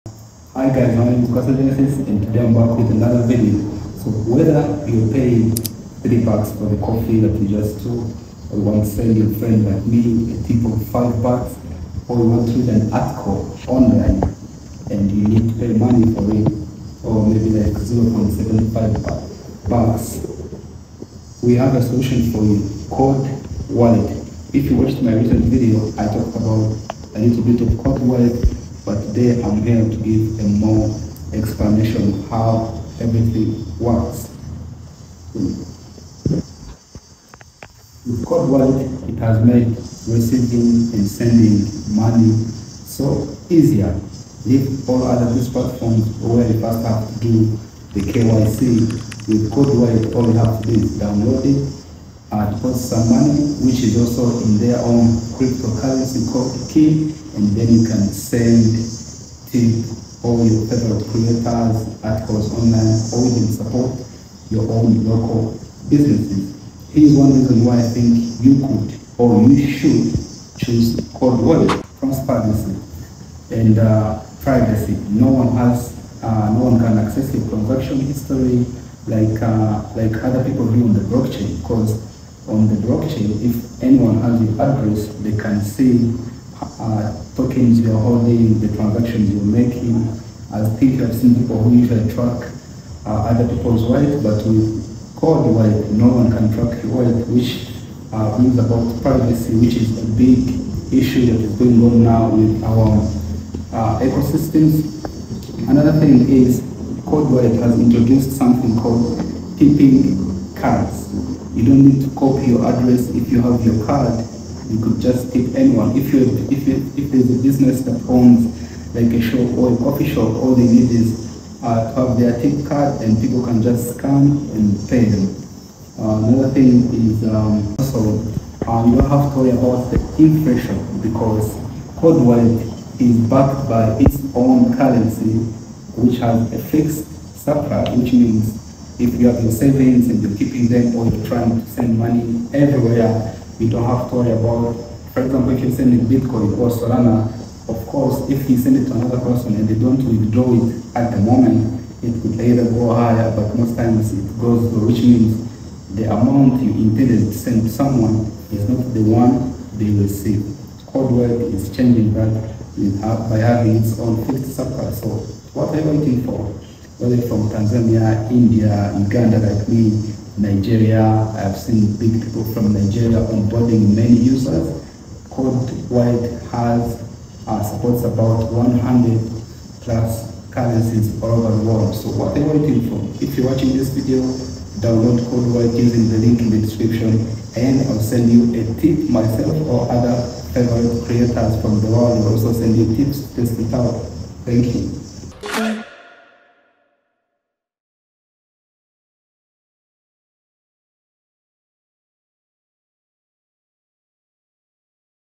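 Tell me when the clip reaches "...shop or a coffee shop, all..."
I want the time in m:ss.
1:59.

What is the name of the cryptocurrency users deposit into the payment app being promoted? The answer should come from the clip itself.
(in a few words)
Kin.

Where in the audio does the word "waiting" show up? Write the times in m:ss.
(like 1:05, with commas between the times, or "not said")
2:45, 3:02.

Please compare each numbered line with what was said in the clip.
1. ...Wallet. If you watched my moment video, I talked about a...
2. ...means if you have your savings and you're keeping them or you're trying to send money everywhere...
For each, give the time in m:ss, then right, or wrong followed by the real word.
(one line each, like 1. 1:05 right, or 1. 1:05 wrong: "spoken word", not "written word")
1. 0:23 wrong: "recent", not "moment"
2. 2:18 right.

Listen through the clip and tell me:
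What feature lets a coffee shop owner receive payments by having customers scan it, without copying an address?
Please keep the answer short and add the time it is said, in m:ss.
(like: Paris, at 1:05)
tipping cards, at 1:49.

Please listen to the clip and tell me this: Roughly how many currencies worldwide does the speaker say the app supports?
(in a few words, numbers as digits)
100 plus.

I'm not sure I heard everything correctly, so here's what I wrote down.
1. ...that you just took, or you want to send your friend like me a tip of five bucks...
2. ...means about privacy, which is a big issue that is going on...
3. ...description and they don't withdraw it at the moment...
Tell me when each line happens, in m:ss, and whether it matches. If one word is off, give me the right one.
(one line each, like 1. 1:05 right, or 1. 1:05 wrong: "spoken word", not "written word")
1. 0:07 right
2. 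1:38 right
3. 2:29 wrong: "person", not "description".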